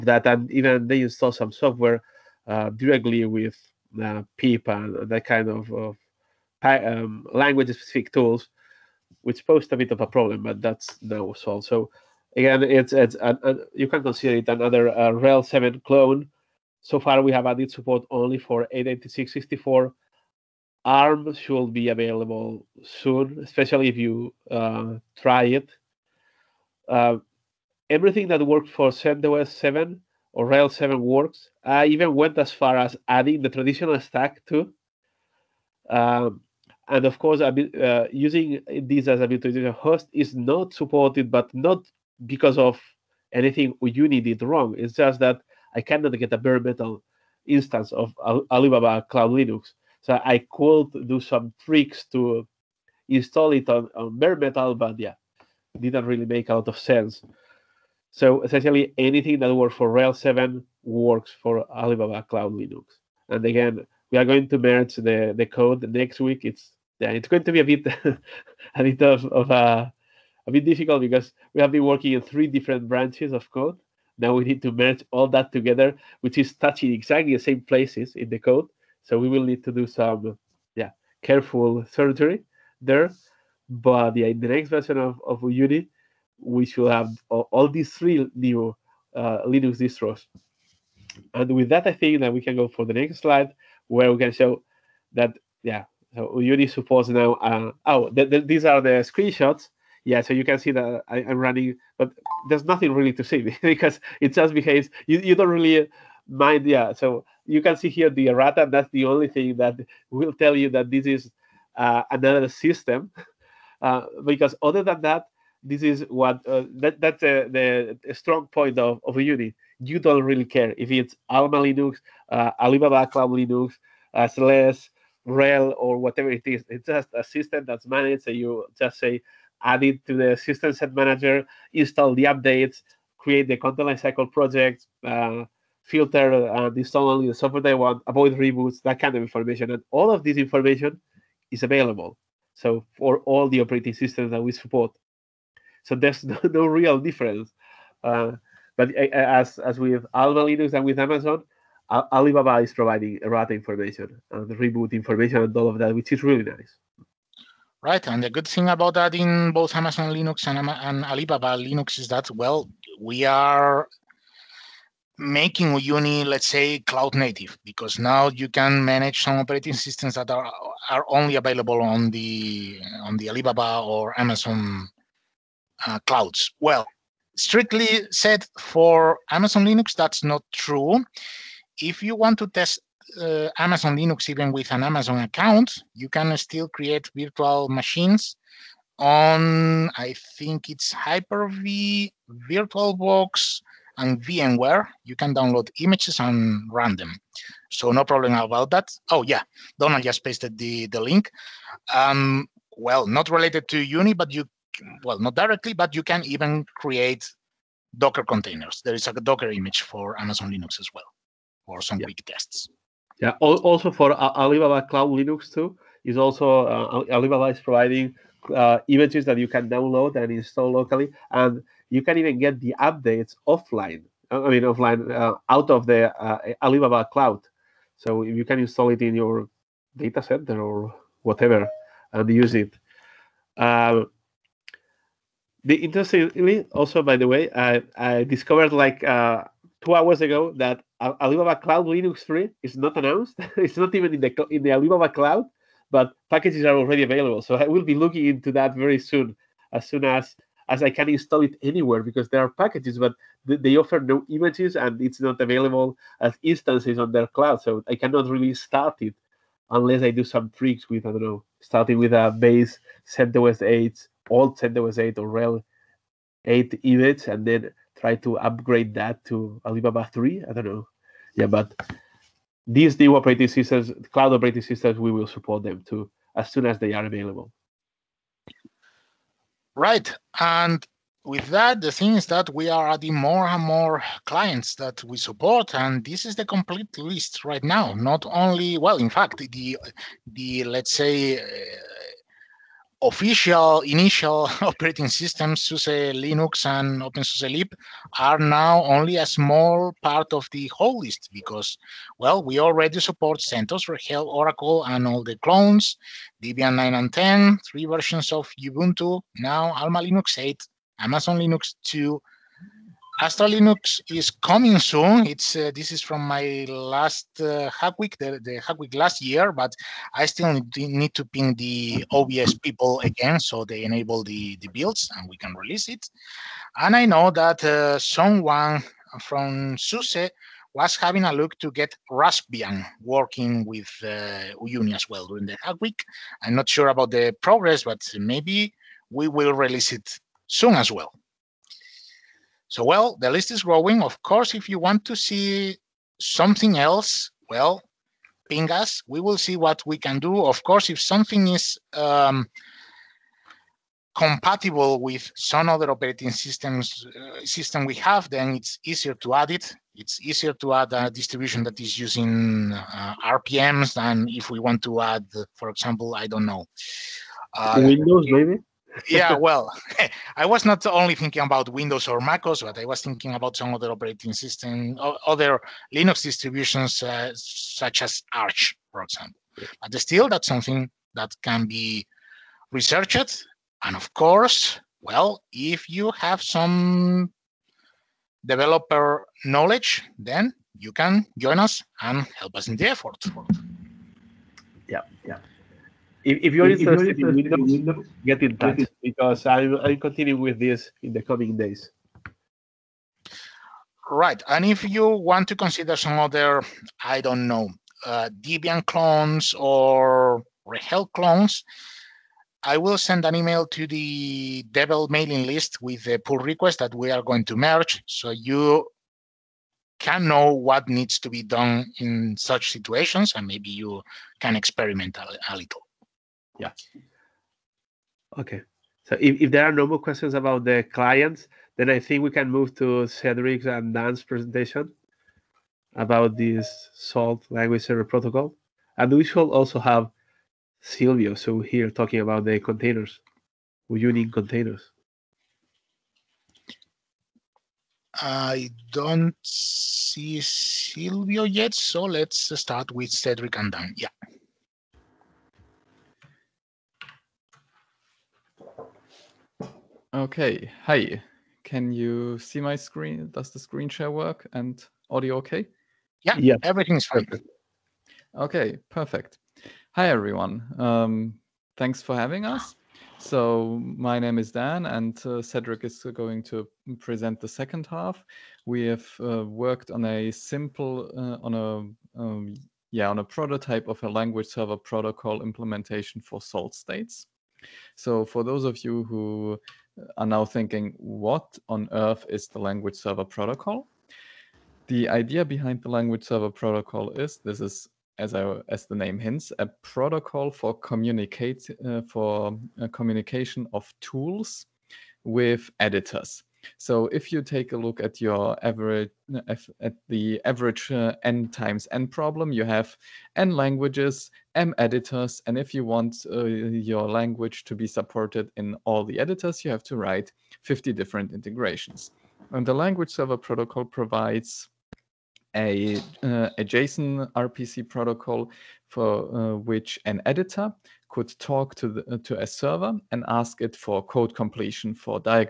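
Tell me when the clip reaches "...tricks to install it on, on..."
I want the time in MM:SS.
00:51.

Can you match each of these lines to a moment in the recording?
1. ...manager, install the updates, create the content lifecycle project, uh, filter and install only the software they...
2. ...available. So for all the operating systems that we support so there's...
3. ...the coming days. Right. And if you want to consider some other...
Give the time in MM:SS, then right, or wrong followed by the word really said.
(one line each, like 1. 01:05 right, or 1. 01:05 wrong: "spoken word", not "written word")
1. 02:10 right
2. 02:21 right
3. 06:41 right.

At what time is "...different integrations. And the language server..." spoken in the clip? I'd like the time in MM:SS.
08:40.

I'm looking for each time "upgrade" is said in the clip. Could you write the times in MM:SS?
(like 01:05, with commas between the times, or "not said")
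04:28.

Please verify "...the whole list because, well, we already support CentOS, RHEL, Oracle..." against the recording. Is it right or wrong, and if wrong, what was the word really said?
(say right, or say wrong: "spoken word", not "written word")
right.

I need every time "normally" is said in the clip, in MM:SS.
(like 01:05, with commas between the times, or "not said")
not said.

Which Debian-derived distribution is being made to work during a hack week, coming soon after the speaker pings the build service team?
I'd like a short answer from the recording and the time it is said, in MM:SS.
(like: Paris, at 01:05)
Astra Linux, at 05:13.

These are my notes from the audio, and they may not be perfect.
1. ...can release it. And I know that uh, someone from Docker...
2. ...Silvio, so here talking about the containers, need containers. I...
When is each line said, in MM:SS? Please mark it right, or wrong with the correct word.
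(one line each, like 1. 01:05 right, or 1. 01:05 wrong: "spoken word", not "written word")
1. 05:25 wrong: "SUSE", not "Docker"
2. 07:20 right.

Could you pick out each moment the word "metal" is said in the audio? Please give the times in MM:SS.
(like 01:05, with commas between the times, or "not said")
00:46, 00:54.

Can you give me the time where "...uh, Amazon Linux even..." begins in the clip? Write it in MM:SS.
03:03.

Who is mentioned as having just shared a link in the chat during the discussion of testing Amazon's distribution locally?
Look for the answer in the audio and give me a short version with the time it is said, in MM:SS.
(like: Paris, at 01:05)
Donald, at 03:19.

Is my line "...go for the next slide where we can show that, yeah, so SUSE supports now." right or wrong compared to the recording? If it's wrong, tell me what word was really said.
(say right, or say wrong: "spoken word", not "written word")
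wrong: "Uyuni", not "SUSE".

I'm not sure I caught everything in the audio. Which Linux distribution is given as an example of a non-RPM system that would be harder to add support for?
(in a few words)
Arch.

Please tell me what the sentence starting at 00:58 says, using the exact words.
So essentially, anything that works for RHEL 7 works for Alibaba Cloud Linux.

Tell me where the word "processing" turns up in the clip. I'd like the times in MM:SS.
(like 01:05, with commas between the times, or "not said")
not said.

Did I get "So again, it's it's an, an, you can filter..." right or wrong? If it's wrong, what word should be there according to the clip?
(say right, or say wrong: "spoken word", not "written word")
wrong: "consider", not "filter".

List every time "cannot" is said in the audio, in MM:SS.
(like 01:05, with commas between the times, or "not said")
00:45, 04:17.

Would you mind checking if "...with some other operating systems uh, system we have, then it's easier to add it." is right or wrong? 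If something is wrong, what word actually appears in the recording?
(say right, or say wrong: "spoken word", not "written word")
right.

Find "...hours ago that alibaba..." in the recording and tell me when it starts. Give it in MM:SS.
03:59.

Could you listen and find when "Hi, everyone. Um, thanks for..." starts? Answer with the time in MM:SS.
07:49.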